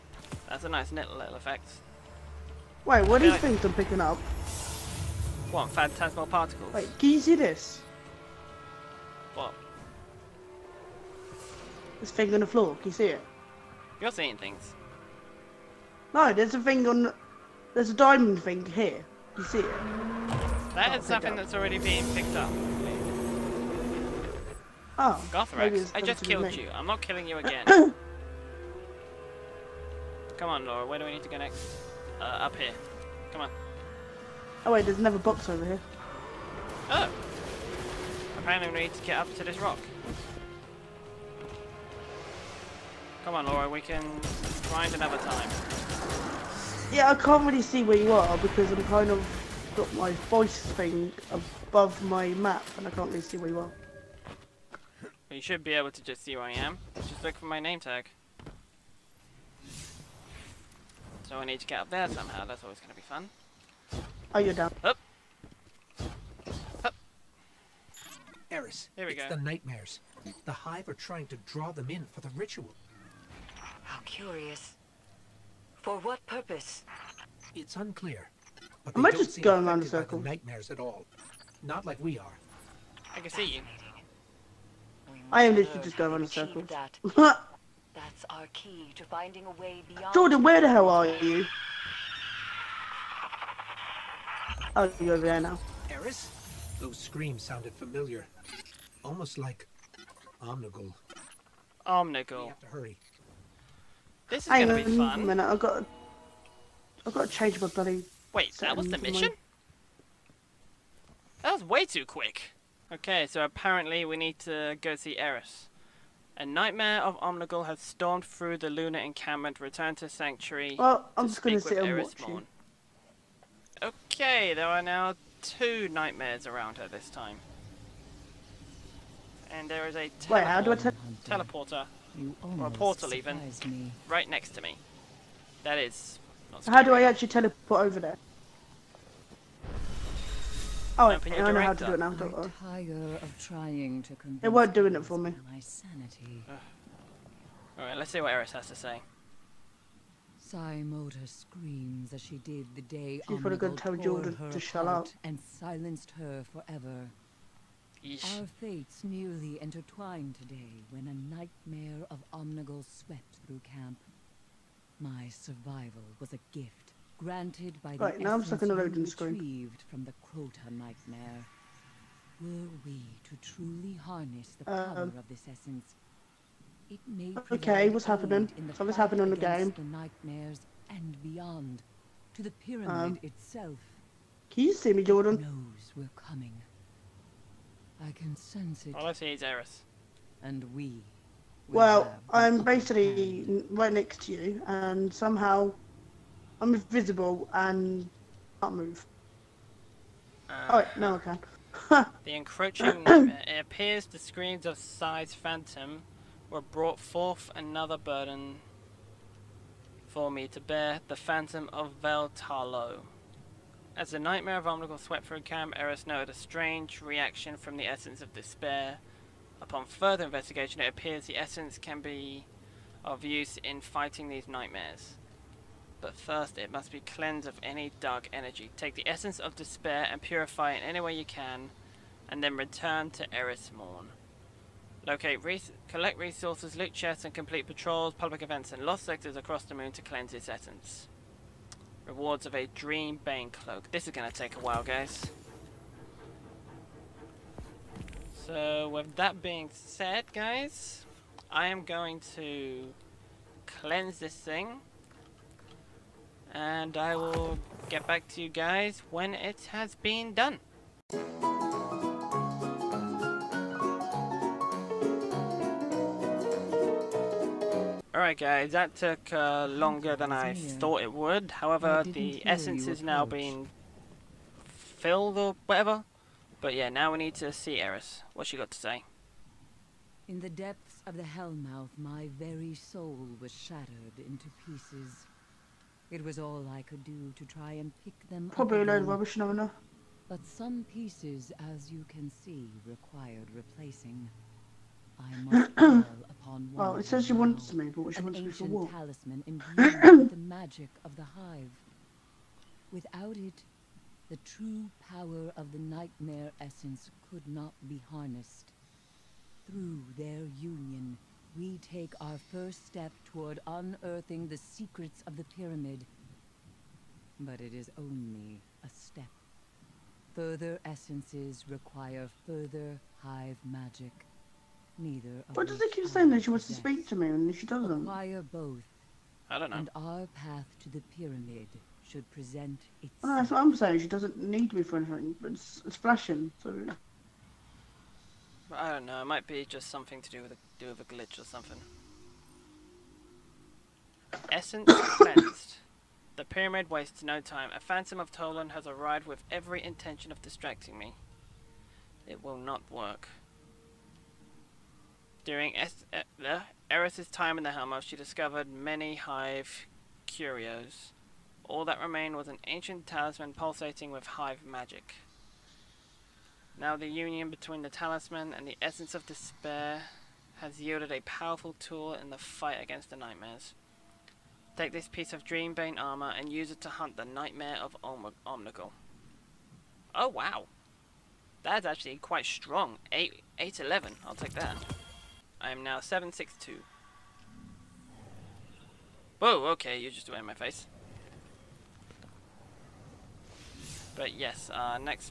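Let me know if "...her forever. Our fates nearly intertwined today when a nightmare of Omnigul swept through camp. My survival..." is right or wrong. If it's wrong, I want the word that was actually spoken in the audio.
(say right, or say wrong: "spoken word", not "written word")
right.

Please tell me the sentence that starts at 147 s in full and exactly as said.
All right, let's see what Eris has to say.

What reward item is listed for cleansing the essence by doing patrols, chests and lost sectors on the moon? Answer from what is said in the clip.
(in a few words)
Dreambane Cloak.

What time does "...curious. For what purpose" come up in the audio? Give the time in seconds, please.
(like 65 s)
74 s.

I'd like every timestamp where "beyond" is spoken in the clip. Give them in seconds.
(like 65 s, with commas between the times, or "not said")
89 s, 181 s.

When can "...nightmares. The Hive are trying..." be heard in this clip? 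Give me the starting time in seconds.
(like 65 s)
69 s.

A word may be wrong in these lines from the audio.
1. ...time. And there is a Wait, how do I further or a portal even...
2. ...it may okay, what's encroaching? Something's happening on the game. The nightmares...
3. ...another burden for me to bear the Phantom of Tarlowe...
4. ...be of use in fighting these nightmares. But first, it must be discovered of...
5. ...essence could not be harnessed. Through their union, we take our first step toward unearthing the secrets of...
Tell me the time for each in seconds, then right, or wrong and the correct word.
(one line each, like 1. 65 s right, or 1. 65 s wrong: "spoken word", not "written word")
1. 127 s wrong: "teleporter", not "further"
2. 176 s wrong: "happening", not "encroaching"
3. 207 s wrong: "Vell", not "Tarlowe"
4. 222 s wrong: "cleansed", not "discovered"
5. 306 s right.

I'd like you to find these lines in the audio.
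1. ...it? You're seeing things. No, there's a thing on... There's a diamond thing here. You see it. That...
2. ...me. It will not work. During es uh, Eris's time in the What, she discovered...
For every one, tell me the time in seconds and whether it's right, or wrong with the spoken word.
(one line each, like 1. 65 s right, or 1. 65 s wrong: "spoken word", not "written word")
1. 13 s right
2. 350 s wrong: "Hellmouth", not "What".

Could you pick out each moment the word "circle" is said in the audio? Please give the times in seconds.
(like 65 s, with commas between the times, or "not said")
79 s, 86 s.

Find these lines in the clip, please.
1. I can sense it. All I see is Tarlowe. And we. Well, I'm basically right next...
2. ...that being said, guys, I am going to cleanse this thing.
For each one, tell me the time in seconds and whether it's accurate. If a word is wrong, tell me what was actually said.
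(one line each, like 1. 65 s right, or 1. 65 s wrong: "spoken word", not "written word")
1. 188 s wrong: "Eris", not "Tarlowe"
2. 249 s right.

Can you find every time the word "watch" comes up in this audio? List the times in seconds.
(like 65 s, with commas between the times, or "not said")
122 s.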